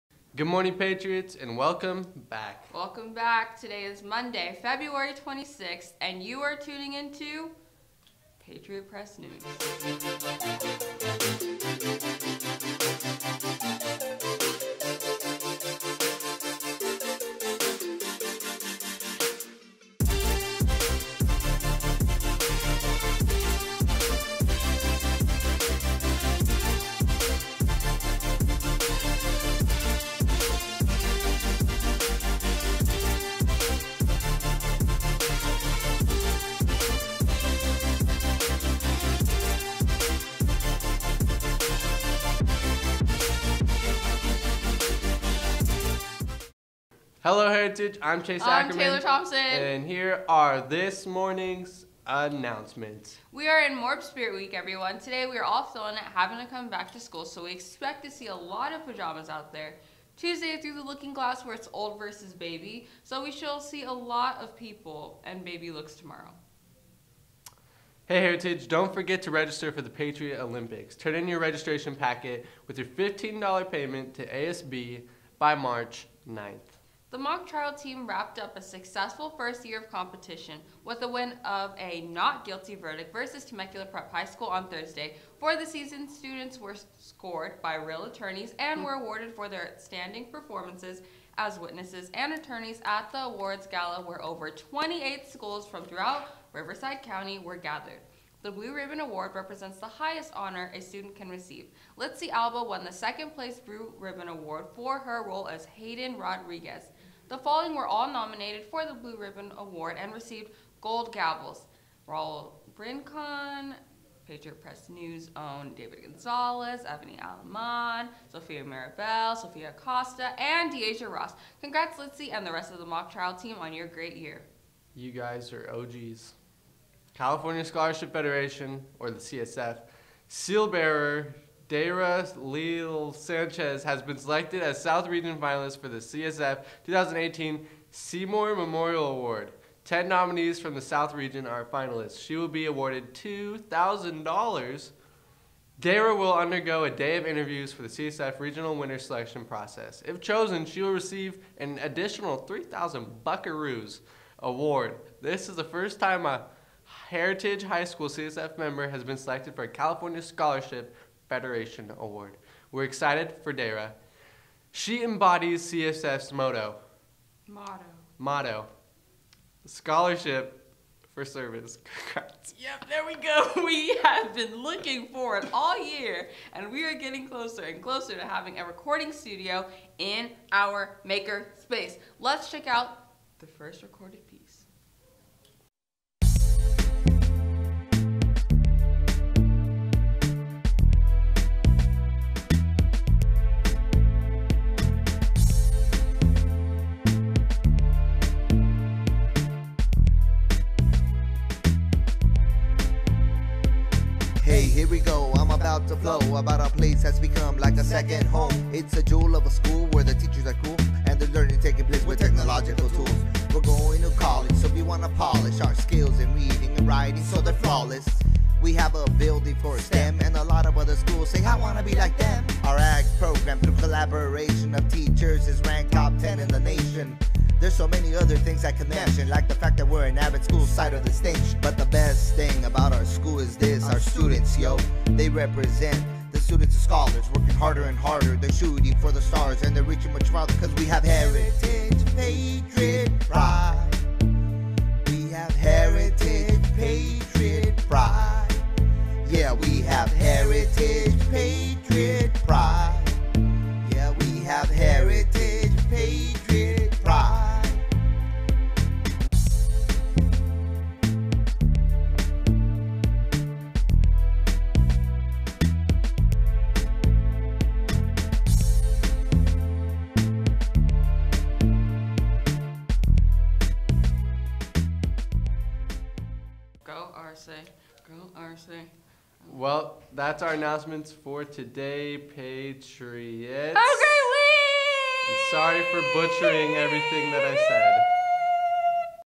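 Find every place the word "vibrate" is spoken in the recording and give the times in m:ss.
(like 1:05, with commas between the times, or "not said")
not said.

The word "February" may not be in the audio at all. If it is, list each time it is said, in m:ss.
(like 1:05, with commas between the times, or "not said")
0:04.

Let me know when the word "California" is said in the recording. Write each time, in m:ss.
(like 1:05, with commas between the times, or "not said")
2:07, 2:39.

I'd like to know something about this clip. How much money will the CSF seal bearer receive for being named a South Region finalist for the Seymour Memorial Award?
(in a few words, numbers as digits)
$2,000.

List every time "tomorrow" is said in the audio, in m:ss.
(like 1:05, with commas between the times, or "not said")
1:05.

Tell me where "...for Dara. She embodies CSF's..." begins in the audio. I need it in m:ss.
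2:43.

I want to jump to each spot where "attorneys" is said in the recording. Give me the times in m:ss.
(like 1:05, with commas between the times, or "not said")
1:28, 1:32.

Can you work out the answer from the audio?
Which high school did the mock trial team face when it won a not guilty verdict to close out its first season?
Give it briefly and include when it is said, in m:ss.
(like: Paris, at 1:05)
Temecula Prep High School, at 1:23.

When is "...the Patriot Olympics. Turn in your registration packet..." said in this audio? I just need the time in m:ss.
1:09.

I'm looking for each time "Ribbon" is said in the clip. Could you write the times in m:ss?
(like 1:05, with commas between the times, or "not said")
1:38, 1:43, 1:49.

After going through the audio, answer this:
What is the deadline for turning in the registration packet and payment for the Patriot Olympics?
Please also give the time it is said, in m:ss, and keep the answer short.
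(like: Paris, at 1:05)
March 9th, at 1:15.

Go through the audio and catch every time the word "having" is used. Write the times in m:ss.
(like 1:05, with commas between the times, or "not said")
0:56, 2:58.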